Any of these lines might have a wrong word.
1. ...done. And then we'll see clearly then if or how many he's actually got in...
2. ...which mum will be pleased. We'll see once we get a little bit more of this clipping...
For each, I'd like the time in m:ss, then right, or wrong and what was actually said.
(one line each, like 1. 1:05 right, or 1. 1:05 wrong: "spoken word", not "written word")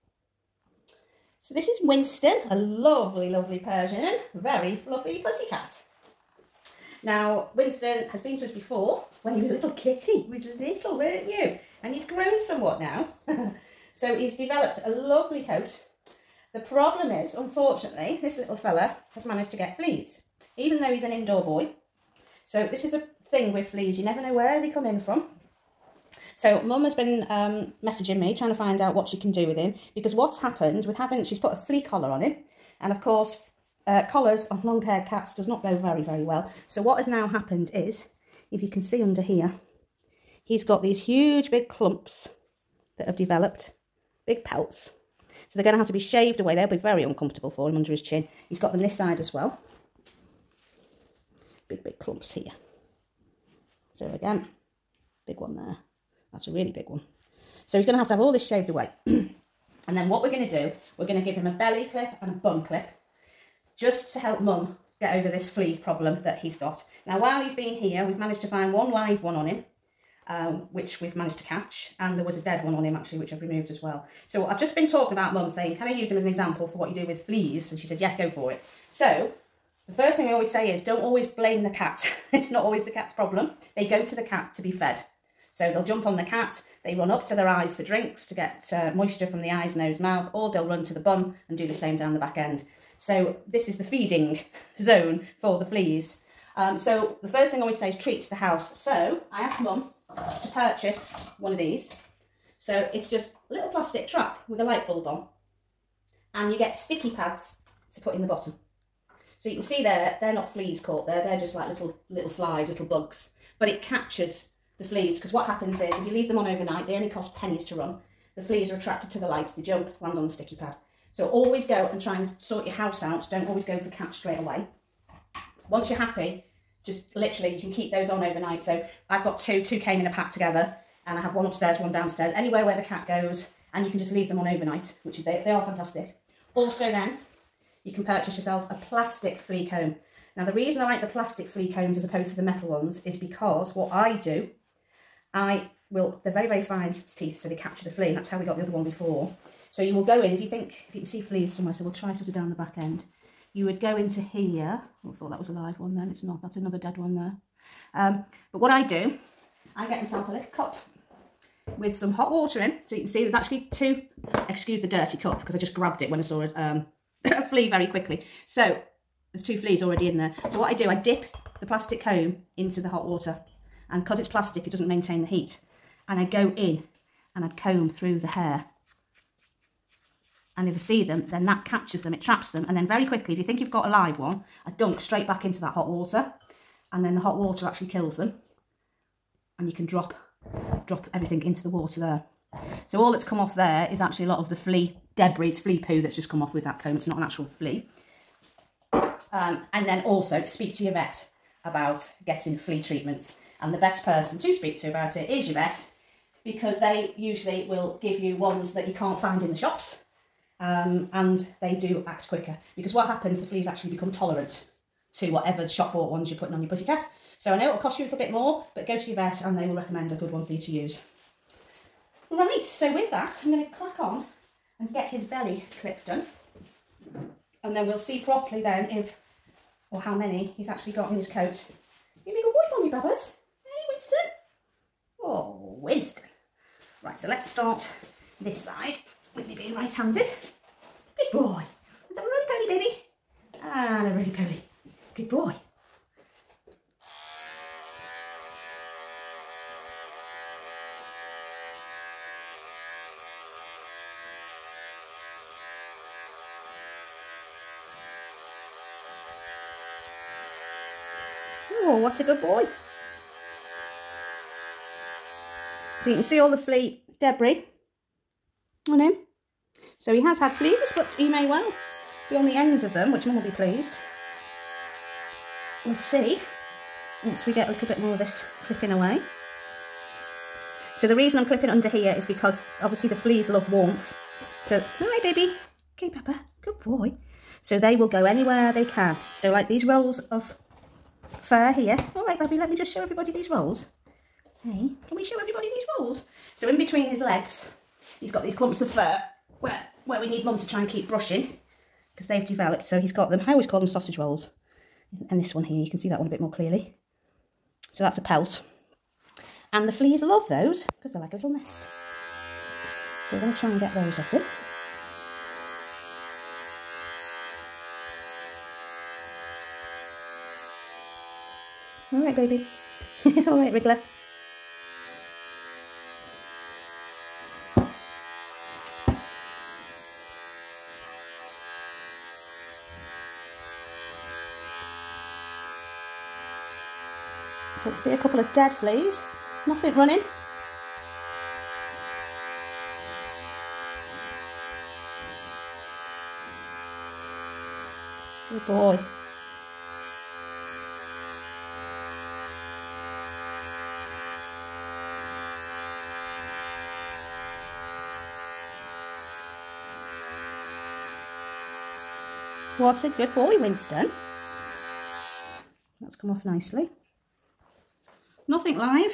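1. 3:46 wrong: "properly", not "clearly"
2. 4:33 right.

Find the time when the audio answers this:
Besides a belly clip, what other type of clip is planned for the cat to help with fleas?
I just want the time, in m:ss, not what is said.
1:02.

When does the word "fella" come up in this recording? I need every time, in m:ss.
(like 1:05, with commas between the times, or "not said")
0:18.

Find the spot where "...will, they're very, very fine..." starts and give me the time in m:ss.
2:25.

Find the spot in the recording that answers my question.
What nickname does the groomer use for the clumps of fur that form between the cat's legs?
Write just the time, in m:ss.
5:03.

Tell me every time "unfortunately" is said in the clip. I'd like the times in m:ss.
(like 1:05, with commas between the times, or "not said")
0:17.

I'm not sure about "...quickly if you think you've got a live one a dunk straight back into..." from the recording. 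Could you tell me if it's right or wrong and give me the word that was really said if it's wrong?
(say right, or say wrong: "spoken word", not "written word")
right.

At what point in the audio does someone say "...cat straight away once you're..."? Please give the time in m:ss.
2:03.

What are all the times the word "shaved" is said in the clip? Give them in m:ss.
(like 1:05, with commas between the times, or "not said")
0:45, 0:58.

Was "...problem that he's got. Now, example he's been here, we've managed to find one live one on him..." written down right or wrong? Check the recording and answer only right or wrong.
wrong.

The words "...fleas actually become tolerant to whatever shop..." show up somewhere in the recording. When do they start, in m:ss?
3:33.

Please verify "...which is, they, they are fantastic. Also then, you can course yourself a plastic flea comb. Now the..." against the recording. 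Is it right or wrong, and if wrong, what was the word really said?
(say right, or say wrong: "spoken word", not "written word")
wrong: "purchase", not "course".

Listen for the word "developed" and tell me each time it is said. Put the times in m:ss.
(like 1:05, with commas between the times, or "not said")
0:14, 0:43, 5:02.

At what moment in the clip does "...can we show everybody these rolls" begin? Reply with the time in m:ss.
4:55.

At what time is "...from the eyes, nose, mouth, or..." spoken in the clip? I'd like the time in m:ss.
1:29.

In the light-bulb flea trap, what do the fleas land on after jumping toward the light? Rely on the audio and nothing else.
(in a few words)
sticky pad.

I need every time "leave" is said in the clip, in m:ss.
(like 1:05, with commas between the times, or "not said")
1:56, 2:14.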